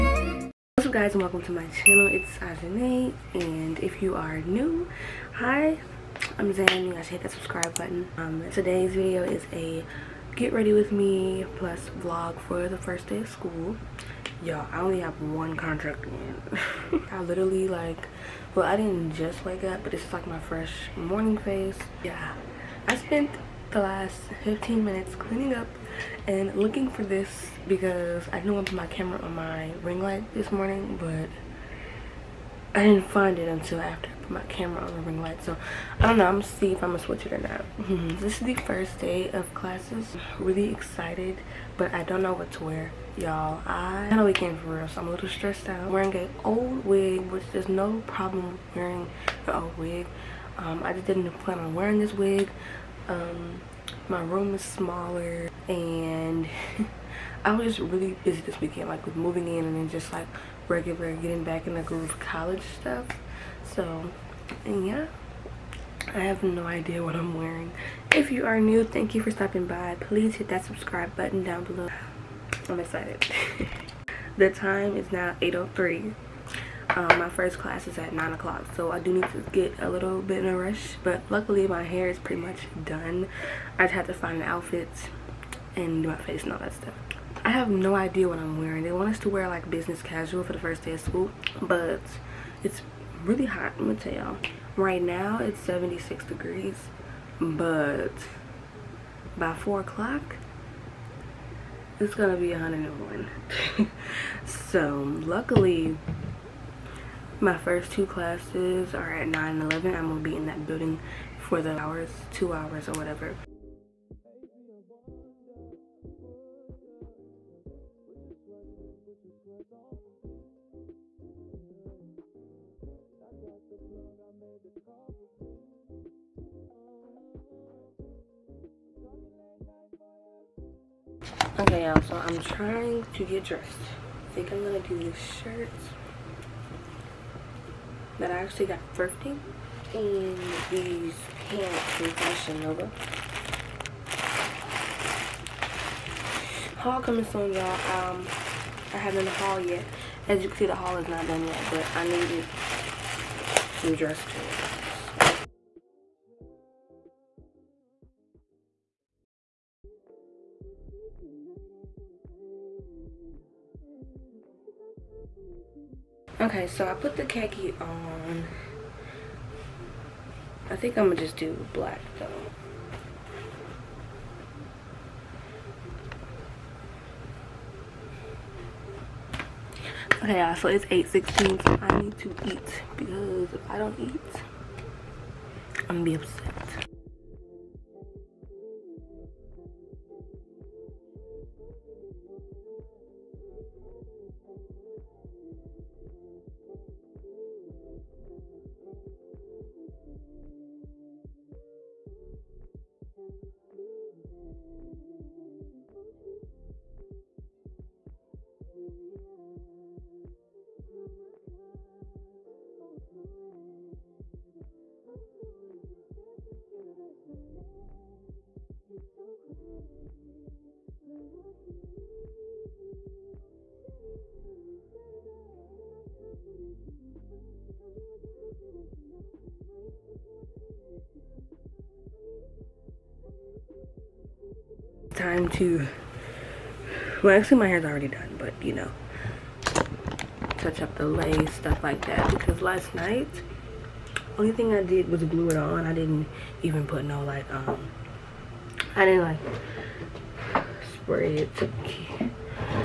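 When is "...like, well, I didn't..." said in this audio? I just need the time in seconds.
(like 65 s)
17 s.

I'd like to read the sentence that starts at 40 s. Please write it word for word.
really excited, but I don't know what to wear, y'all.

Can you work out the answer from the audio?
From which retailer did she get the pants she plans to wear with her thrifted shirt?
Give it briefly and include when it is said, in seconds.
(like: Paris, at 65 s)
Fashion Nova, at 142 s.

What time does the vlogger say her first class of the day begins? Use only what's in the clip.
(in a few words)
9 o'clock.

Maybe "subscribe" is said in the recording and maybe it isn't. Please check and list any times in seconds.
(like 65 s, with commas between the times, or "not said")
7 s, 70 s.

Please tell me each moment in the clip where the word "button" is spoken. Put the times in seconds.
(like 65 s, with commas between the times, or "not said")
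7 s, 71 s.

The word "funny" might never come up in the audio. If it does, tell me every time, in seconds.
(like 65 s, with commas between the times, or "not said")
not said.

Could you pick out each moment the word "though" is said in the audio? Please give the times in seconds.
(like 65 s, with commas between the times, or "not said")
172 s.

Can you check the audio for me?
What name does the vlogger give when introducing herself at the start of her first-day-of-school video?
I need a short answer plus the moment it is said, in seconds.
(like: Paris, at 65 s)
Zan, at 6 s.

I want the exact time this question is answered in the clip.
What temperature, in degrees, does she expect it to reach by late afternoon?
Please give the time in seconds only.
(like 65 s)
102 s.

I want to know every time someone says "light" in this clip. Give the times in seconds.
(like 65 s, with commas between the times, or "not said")
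30 s, 35 s.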